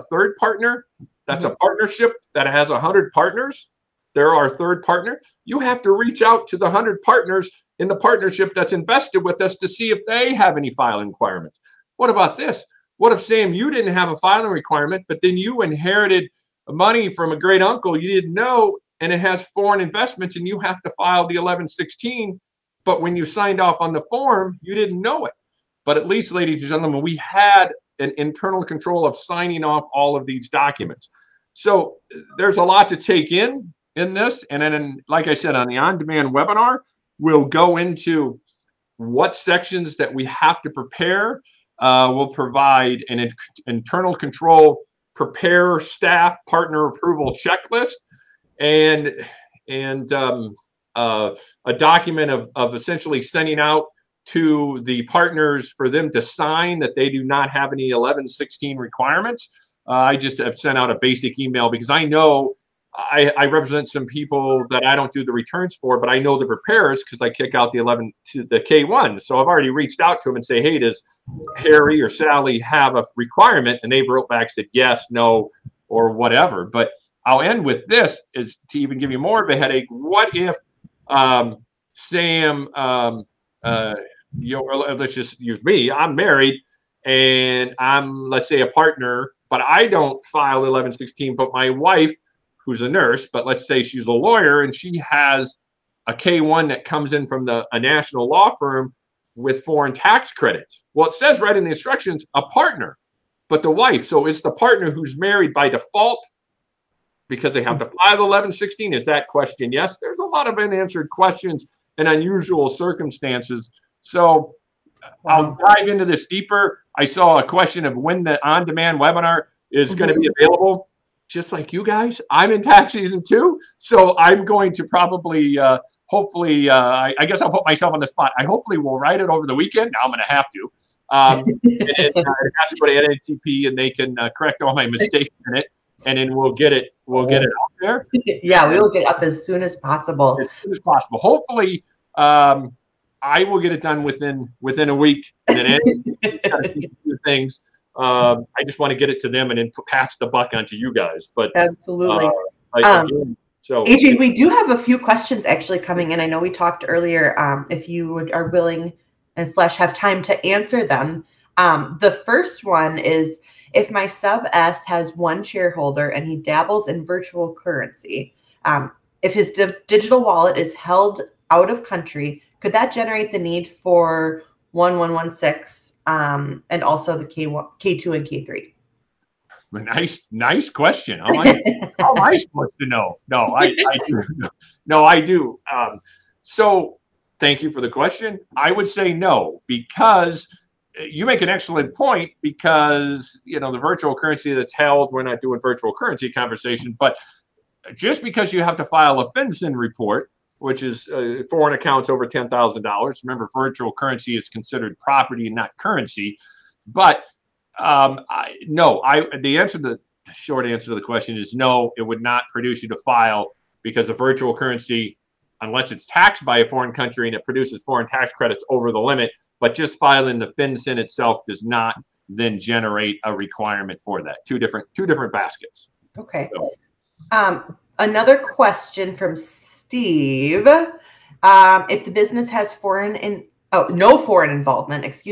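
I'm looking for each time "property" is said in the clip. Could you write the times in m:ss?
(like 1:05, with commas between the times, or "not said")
3:24.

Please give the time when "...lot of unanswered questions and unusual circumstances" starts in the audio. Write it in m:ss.
1:50.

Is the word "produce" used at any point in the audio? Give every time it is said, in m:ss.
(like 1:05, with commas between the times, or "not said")
3:32, 3:37.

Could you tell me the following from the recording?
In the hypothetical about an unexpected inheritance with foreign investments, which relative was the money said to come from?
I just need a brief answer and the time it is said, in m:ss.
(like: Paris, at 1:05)
great uncle, at 0:17.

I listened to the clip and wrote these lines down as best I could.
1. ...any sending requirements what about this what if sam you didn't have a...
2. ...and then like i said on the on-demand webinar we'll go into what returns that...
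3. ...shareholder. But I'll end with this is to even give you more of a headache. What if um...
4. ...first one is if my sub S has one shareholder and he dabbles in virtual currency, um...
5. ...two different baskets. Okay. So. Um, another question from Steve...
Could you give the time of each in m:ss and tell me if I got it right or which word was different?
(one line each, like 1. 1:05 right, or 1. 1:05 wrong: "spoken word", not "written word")
1. 0:10 wrong: "filing", not "sending"
2. 0:34 wrong: "sections", not "returns"
3. 1:16 wrong: "whatever", not "shareholder"
4. 2:42 right
5. 3:44 right.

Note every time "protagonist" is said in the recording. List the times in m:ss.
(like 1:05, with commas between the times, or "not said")
not said.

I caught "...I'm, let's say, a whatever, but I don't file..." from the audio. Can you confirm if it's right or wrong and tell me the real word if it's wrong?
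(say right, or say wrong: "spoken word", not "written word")
wrong: "partner", not "whatever".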